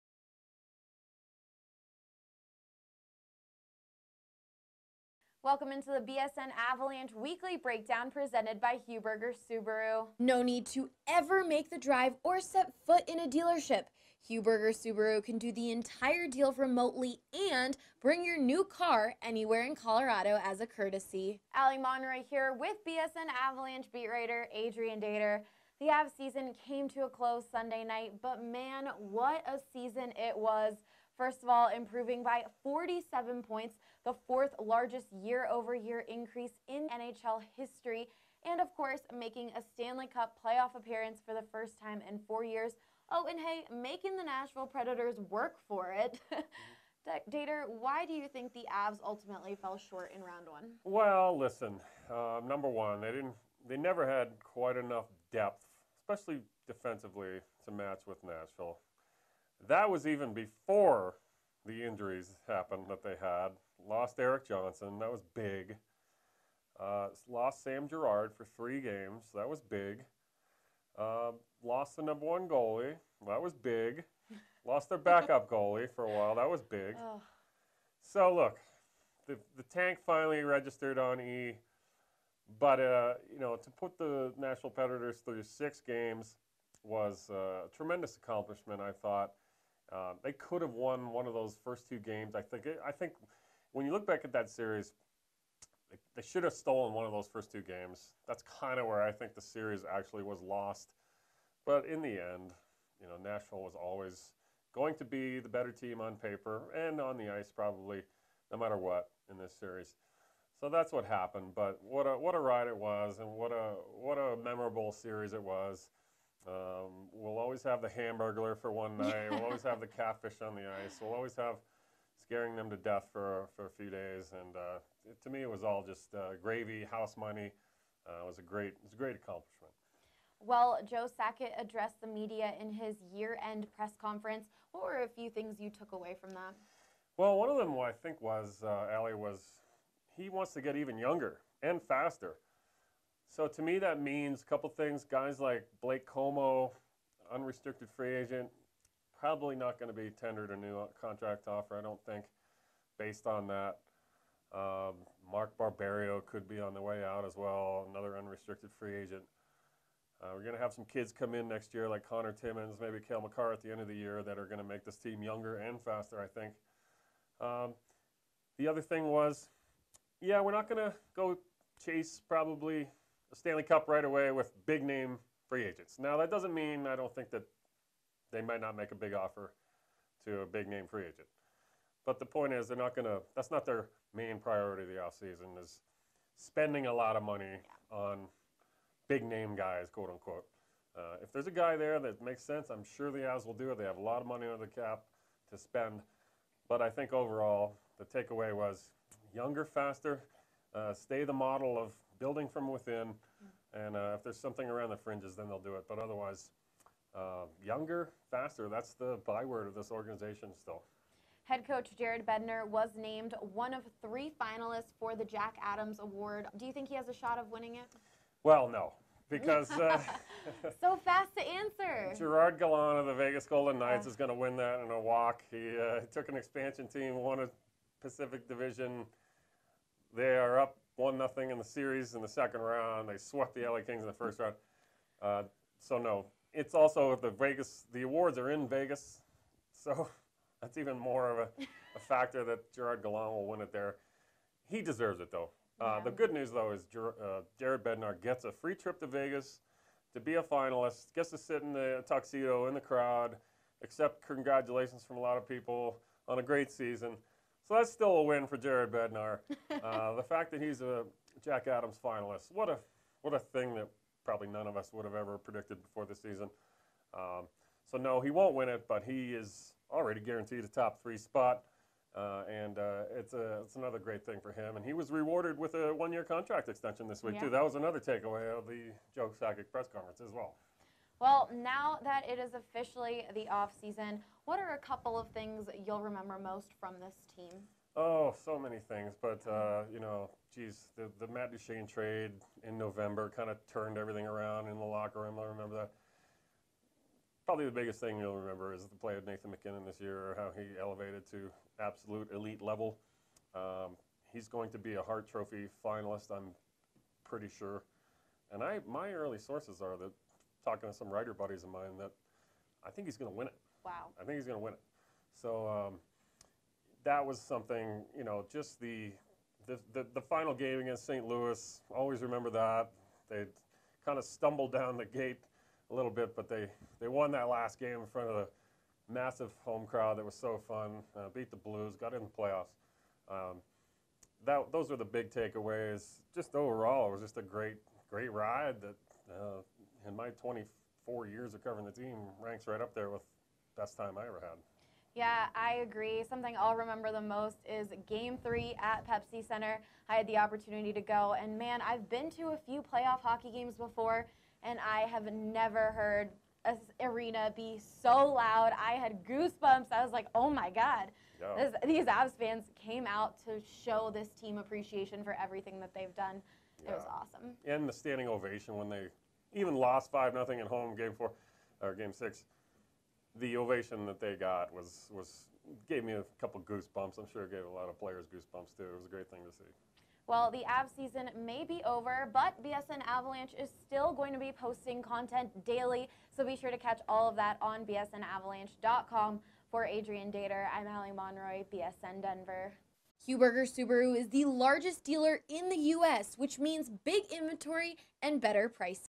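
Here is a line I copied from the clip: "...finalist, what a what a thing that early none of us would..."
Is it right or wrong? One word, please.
wrong.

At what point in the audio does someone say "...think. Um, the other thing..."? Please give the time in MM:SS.
02:46.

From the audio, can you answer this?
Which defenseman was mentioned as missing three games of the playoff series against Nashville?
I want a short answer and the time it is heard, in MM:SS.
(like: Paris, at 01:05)
Sam Girard, at 01:07.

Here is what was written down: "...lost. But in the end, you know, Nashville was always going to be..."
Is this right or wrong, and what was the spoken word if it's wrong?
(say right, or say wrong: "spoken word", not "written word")
right.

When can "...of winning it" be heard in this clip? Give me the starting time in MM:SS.
03:37.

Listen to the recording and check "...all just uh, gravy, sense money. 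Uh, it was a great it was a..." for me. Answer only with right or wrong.
wrong.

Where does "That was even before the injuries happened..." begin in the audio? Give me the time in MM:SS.
00:59.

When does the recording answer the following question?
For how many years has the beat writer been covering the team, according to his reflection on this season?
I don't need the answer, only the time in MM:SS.
05:40.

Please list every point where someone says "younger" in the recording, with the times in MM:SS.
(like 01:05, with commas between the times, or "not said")
02:20, 02:45, 03:19, 03:27.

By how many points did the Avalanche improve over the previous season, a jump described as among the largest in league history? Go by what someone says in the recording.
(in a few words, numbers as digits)
47.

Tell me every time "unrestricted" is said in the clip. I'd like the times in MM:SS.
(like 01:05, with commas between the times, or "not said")
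02:27, 02:38.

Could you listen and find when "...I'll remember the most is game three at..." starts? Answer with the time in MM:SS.
05:46.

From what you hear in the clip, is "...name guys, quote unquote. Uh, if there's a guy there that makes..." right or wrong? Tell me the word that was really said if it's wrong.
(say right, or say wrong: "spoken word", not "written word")
right.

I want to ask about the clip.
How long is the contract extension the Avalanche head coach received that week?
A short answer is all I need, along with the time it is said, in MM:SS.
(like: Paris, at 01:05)
One year, at 04:35.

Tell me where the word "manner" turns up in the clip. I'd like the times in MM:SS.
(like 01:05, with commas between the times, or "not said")
not said.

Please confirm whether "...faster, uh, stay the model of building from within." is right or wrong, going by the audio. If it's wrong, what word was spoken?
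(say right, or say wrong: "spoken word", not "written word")
right.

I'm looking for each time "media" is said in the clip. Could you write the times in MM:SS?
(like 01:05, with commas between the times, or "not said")
02:12.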